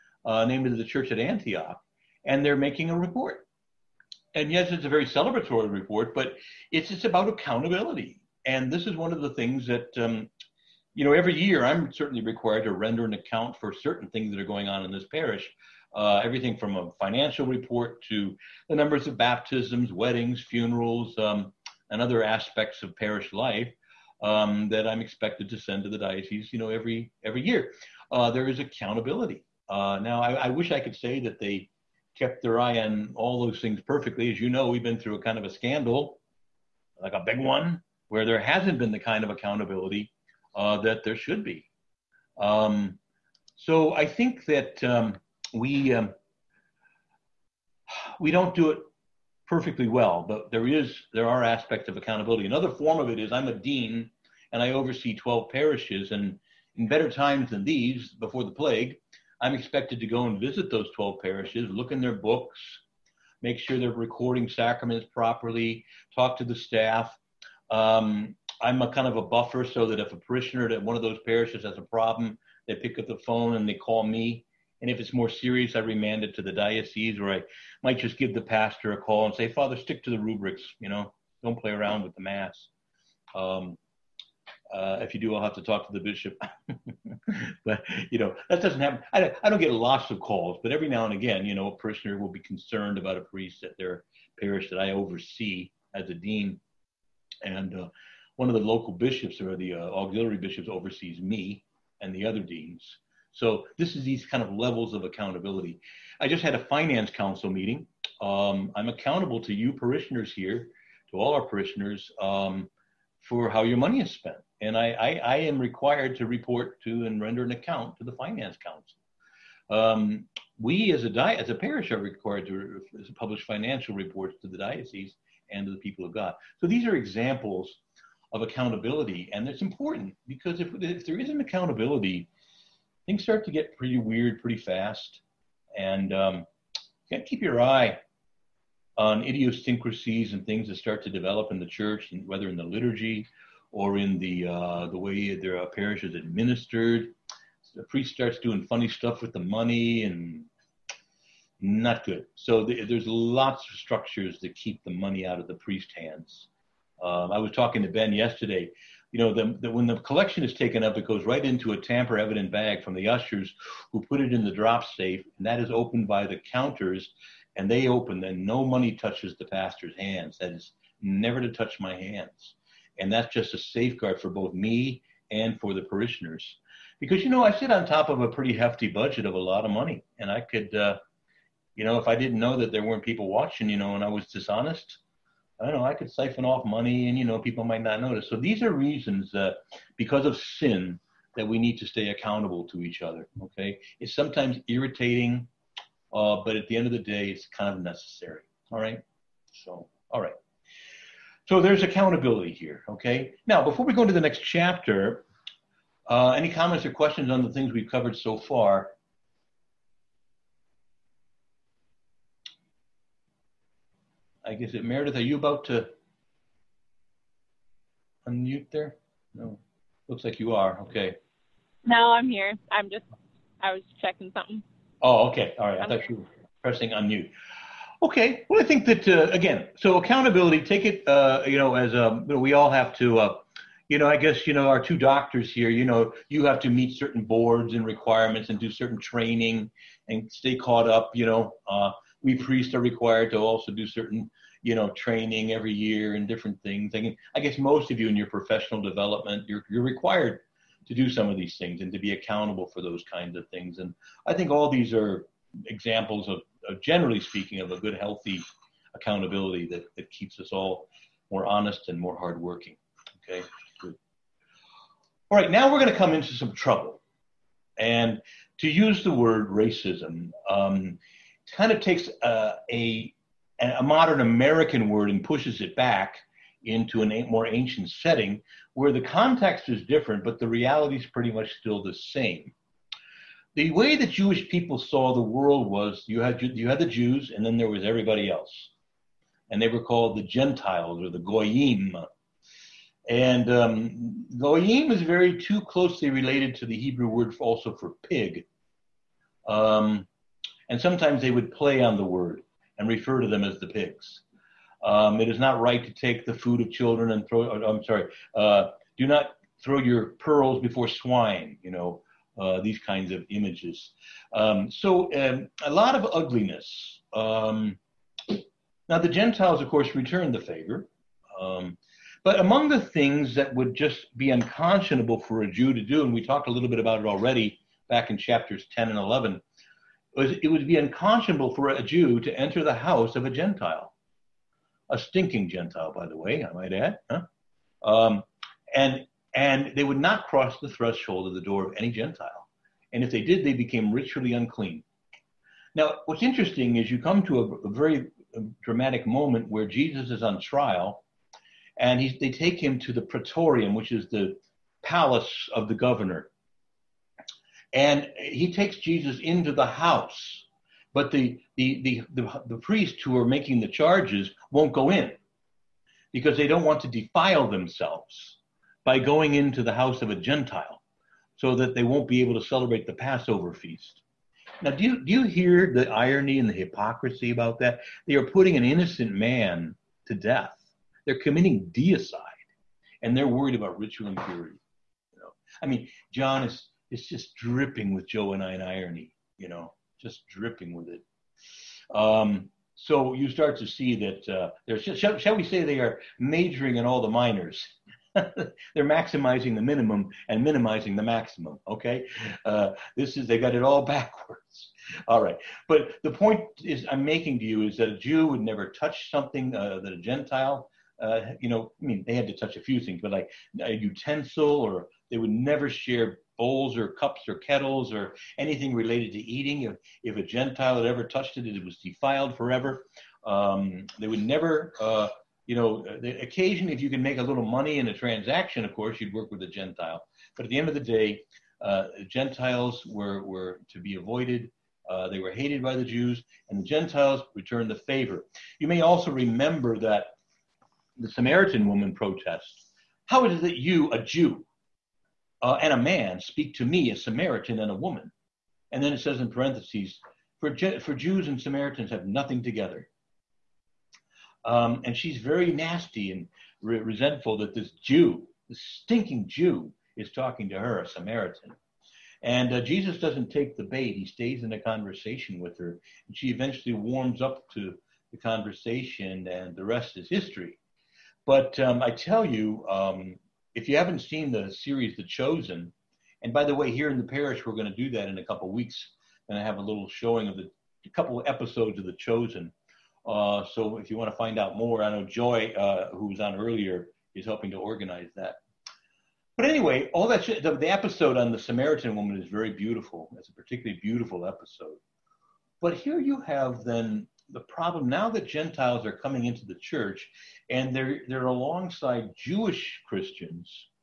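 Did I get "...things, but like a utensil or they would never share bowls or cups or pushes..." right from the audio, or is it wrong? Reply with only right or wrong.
wrong.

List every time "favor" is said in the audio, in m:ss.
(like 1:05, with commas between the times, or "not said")
5:20, 7:17.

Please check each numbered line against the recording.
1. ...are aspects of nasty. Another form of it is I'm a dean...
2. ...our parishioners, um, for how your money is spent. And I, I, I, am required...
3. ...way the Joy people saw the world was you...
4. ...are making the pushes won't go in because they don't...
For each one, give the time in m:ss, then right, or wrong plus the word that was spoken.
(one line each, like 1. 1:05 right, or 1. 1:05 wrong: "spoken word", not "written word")
1. 0:51 wrong: "accountability", not "nasty"
2. 1:51 right
3. 4:43 wrong: "Jewish", not "Joy"
4. 6:03 wrong: "charges", not "pushes".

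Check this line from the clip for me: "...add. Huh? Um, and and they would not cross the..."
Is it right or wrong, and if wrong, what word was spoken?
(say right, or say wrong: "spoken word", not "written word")
right.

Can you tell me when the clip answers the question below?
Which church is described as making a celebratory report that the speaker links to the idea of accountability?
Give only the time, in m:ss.
0:00.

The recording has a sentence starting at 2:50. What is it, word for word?
That is never to touch my hands.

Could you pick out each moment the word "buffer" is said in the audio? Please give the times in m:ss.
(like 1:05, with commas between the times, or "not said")
1:09.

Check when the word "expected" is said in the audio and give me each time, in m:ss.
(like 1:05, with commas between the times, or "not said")
0:25, 0:59.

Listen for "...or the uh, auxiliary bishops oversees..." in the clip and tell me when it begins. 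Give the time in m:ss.
1:39.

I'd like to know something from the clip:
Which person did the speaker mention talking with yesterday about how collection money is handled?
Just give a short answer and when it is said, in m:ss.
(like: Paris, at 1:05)
Ben, at 2:37.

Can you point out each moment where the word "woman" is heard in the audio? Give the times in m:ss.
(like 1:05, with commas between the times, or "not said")
7:21, 7:27, 8:11.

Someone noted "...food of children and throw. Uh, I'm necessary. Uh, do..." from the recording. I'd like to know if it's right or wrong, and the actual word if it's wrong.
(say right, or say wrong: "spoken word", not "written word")
wrong: "sorry", not "necessary".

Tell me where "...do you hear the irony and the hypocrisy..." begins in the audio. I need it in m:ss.
6:15.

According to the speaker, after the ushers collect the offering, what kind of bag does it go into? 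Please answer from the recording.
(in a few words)
Tamper evident bag.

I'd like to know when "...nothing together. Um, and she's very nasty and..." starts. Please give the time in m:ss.
7:32.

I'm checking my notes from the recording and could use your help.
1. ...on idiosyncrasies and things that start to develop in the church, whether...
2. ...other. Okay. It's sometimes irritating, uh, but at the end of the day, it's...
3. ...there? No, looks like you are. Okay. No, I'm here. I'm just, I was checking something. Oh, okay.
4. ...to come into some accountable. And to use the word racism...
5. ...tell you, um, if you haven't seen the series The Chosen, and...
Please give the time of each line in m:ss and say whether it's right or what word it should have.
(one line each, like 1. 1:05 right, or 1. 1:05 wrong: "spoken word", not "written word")
1. 2:18 right
2. 3:13 right
3. 3:38 right
4. 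4:25 wrong: "trouble", not "accountable"
5. 7:51 right.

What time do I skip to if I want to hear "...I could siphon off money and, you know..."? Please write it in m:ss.
3:05.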